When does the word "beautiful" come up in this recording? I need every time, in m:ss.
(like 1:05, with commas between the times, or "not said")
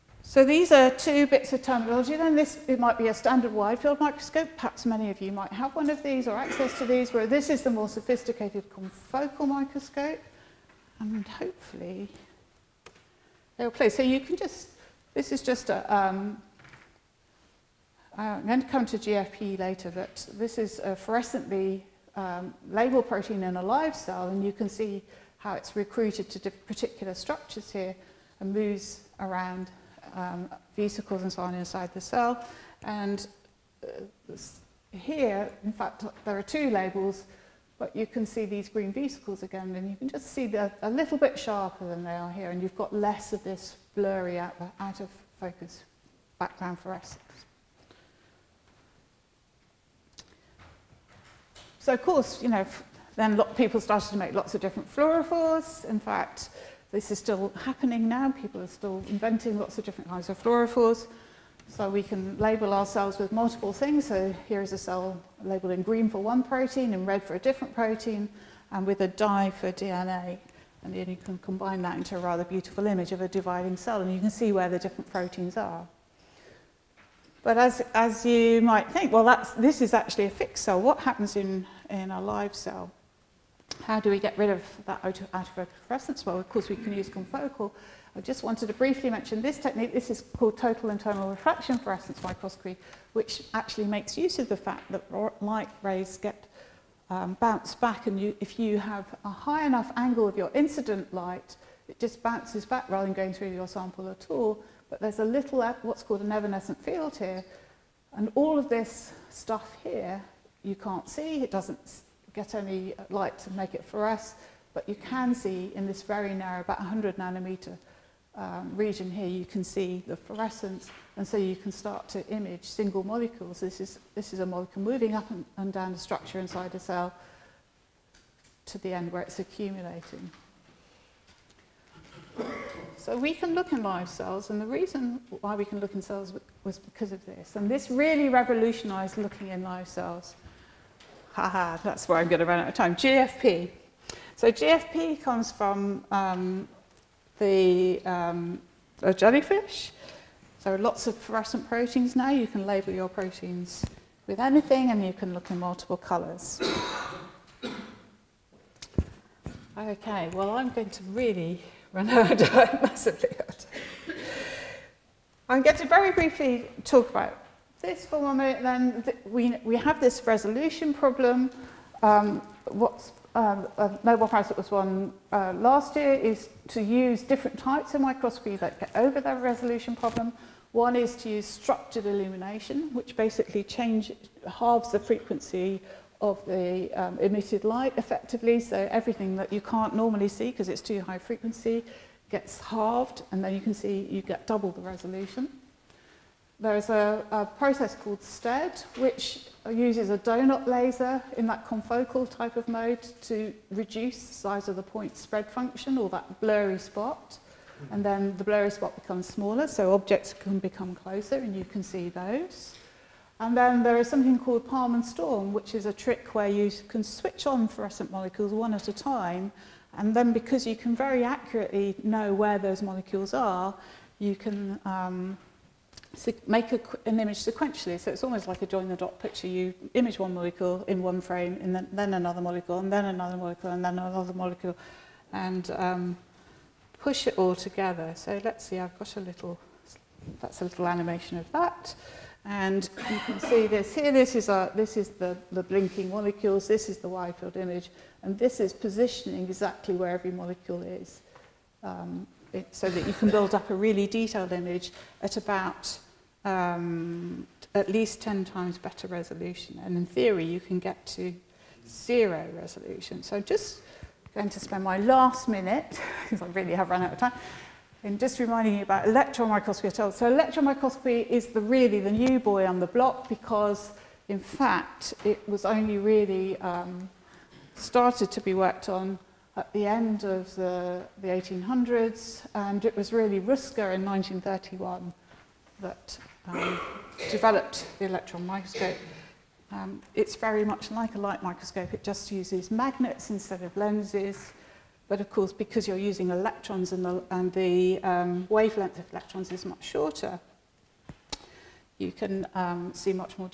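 1:12.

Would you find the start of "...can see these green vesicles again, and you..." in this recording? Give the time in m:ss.
0:38.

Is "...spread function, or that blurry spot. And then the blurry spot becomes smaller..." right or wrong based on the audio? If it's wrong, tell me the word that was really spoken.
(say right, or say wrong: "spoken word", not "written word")
right.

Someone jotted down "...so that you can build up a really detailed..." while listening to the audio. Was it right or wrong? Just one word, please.
right.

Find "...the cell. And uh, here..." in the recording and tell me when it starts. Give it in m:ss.
0:31.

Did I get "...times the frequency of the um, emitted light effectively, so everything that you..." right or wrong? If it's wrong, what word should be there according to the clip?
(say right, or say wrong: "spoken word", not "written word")
wrong: "halves", not "times".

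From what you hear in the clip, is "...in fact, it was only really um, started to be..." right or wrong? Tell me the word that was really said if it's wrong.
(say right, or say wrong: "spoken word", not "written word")
right.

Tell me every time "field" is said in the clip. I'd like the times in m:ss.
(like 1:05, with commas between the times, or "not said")
0:03, 1:46, 4:07.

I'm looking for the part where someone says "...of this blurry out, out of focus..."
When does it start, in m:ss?
0:43.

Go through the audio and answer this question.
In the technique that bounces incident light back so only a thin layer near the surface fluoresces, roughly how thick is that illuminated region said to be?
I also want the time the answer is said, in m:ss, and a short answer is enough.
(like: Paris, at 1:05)
100 nanometers, at 1:56.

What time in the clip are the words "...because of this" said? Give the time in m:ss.
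2:16.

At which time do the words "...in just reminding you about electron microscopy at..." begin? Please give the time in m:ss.
4:28.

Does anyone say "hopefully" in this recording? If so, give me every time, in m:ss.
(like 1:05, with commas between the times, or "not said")
0:11.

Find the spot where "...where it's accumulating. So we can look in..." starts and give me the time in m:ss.
2:09.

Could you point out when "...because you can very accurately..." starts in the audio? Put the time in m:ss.
3:40.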